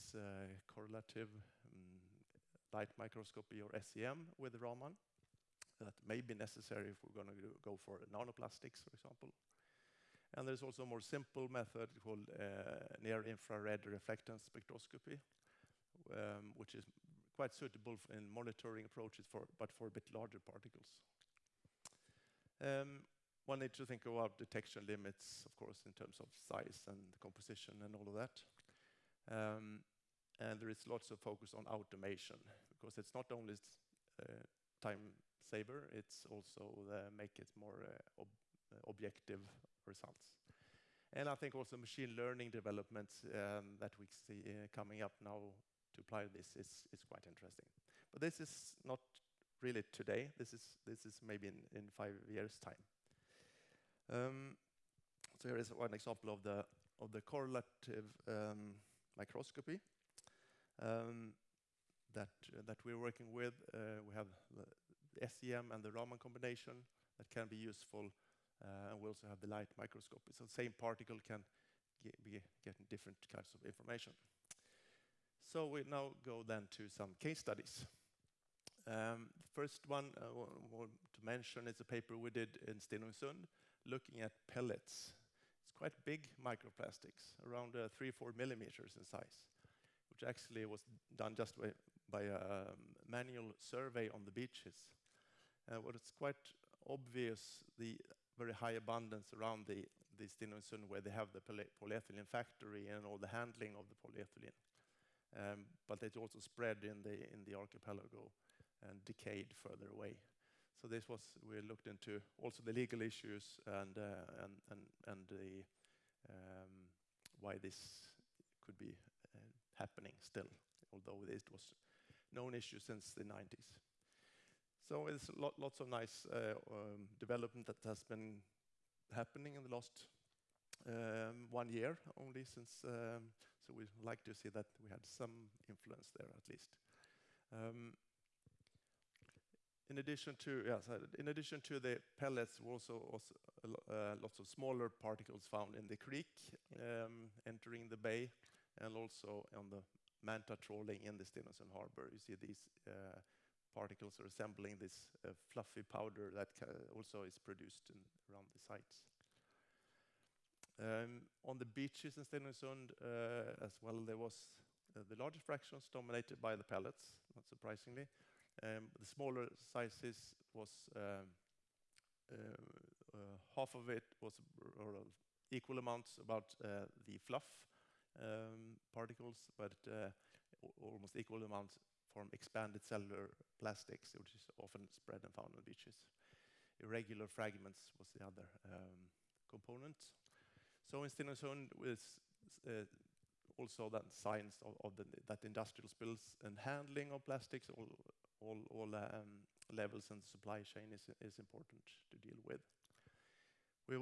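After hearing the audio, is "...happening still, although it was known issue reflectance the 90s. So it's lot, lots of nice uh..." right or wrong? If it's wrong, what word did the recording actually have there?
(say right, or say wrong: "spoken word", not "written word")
wrong: "since", not "reflectance".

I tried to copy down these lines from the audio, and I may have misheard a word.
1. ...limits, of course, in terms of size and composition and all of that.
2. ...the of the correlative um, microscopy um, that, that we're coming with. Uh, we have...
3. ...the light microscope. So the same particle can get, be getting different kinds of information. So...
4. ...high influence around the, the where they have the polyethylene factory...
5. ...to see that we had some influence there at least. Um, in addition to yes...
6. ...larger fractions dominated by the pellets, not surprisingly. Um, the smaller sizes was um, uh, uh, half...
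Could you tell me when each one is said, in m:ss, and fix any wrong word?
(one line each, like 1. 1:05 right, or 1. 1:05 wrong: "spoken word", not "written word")
1. 0:24 right
2. 0:56 wrong: "working", not "coming"
3. 1:09 right
4. 1:38 wrong: "abundance", not "influence"
5. 2:14 right
6. 2:45 right.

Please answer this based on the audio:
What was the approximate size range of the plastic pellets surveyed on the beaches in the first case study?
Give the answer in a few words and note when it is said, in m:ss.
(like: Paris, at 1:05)
3-4 millimeters, at 1:27.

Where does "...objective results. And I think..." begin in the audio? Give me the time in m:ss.
0:38.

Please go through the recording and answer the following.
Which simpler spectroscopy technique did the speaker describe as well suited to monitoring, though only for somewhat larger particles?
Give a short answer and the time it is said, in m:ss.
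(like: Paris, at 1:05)
near-infrared reflectance spectroscopy, at 0:12.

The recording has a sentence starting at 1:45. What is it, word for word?
Um, but it also spread in the, in the archipelago and decayed further away.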